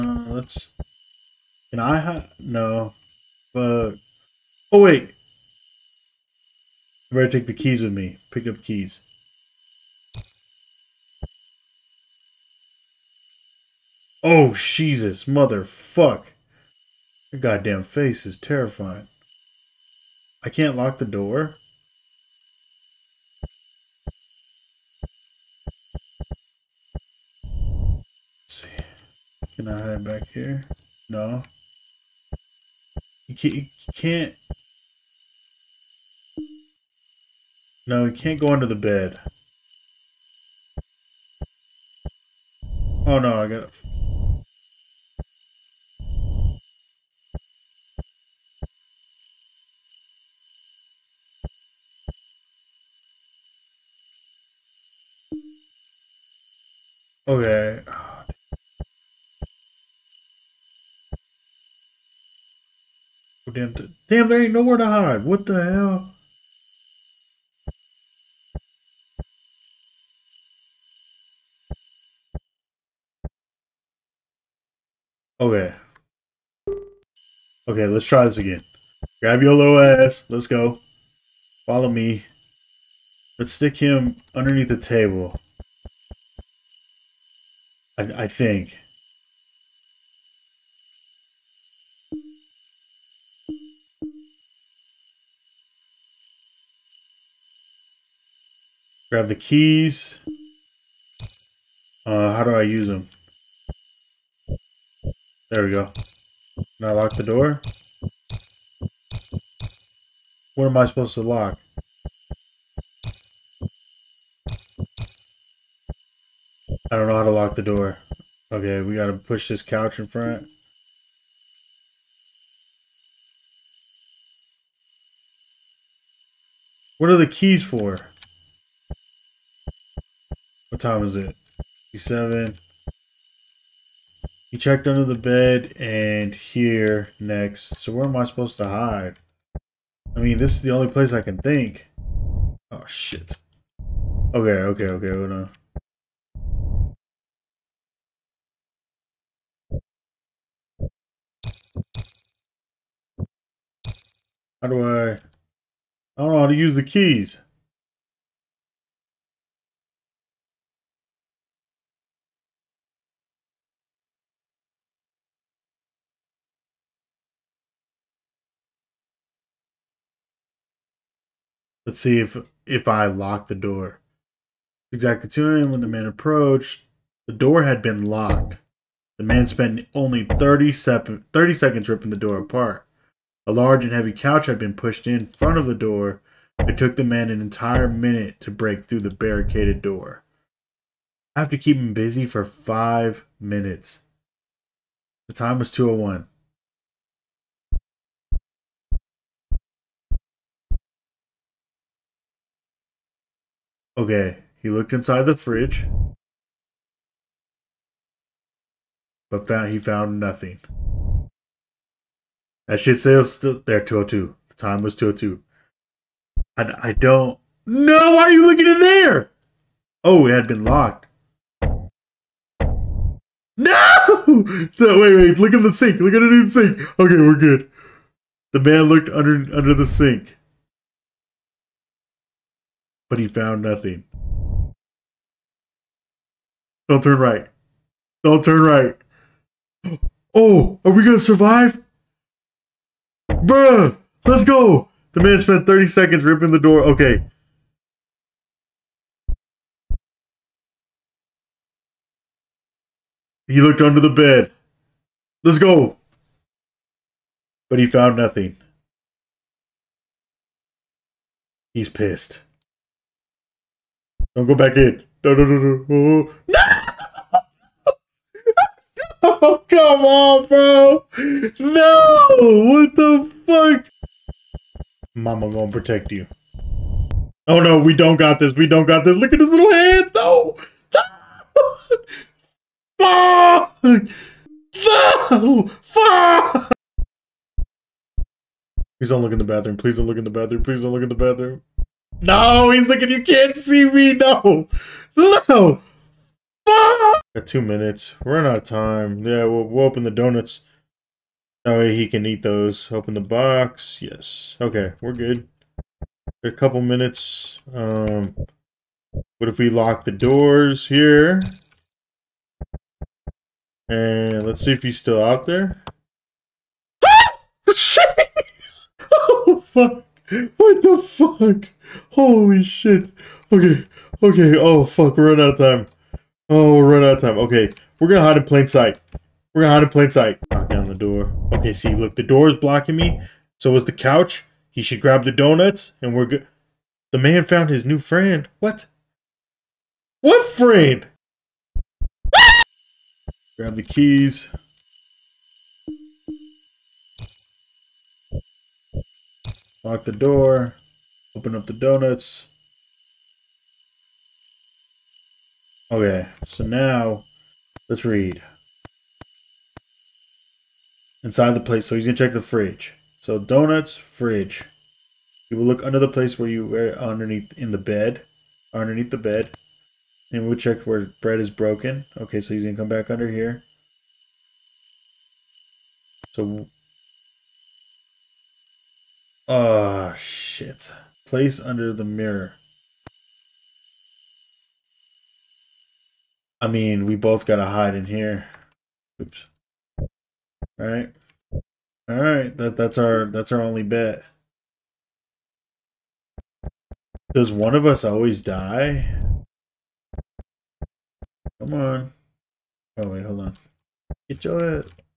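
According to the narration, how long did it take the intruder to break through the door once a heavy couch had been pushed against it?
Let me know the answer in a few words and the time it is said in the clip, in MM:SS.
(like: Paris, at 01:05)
an entire minute, at 03:07.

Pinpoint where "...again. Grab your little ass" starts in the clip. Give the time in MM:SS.
01:18.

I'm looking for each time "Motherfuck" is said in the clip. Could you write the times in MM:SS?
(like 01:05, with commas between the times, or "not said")
00:15.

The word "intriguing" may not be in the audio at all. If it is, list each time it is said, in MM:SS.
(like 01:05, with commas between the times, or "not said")
not said.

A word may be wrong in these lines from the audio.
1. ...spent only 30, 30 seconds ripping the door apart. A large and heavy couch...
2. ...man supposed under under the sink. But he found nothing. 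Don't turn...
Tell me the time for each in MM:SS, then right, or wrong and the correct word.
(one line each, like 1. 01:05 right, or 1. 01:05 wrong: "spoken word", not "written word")
1. 02:59 right
2. 03:48 wrong: "looked", not "supposed".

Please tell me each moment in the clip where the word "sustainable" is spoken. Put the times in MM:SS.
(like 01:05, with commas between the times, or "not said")
not said.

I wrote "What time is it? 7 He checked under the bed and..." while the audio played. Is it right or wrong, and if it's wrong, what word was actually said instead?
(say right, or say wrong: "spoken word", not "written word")
right.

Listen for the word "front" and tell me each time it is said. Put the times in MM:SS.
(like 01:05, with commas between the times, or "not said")
02:00, 03:05.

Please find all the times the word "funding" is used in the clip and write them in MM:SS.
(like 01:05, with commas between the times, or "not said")
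not said.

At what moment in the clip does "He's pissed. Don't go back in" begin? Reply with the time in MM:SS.
04:21.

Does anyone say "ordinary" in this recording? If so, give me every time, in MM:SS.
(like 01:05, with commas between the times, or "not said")
not said.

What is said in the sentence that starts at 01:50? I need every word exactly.
What am I supposed to lock?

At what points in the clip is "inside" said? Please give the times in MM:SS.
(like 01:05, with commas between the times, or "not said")
03:24, 06:01.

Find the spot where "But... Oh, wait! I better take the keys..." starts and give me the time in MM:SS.
00:03.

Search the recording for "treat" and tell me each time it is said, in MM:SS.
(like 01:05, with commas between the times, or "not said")
not said.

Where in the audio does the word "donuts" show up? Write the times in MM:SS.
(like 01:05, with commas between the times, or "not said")
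05:00, 05:35, 05:51, 06:03.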